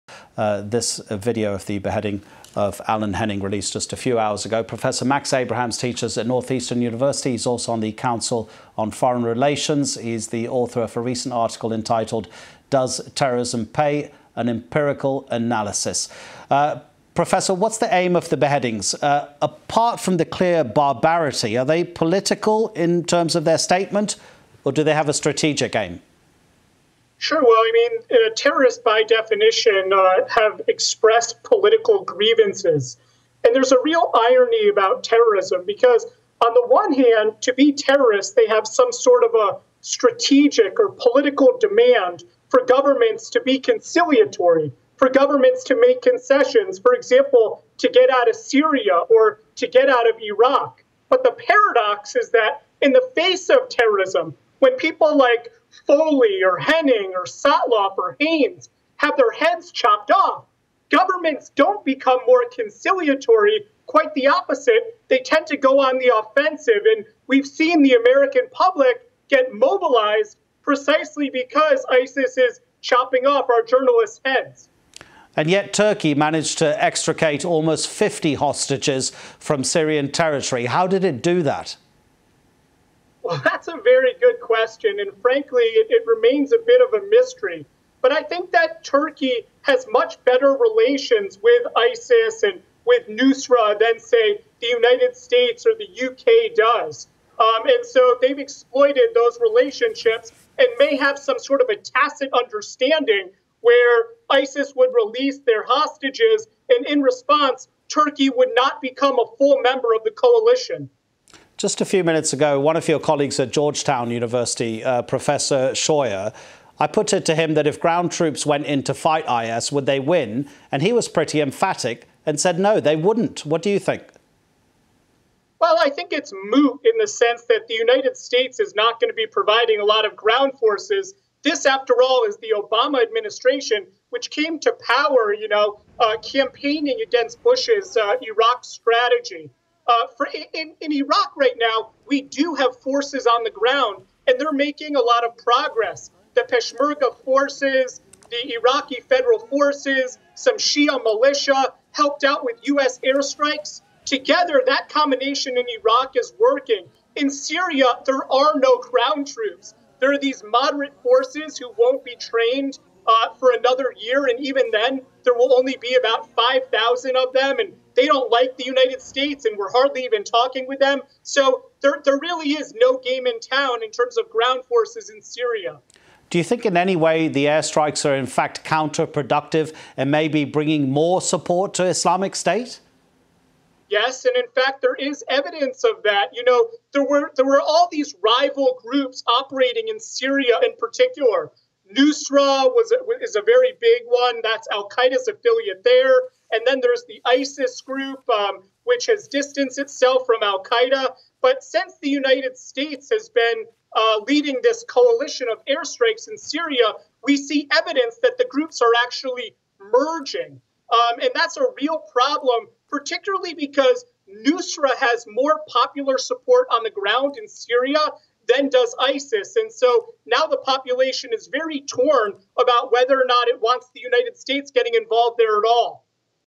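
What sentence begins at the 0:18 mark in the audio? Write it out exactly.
Uh, apart from the clear barbarity, are they political in terms of their statement, or do they have a strategic aim?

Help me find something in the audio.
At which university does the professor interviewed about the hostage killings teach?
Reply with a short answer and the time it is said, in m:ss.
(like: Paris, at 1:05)
Northeastern University, at 0:06.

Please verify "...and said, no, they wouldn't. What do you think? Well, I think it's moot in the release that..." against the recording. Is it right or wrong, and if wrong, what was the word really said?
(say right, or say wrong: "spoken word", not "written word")
wrong: "sense", not "release".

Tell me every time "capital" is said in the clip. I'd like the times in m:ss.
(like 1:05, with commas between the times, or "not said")
not said.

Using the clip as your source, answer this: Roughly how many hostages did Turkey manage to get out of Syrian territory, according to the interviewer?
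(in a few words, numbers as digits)
50.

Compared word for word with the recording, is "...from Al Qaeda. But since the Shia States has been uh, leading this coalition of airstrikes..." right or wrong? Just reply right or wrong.
wrong.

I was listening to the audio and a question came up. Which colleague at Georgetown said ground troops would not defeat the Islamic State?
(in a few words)
Professor Scheuer.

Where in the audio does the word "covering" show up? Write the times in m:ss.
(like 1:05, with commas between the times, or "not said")
not said.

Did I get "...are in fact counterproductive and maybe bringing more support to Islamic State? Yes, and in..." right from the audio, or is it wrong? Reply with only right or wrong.
right.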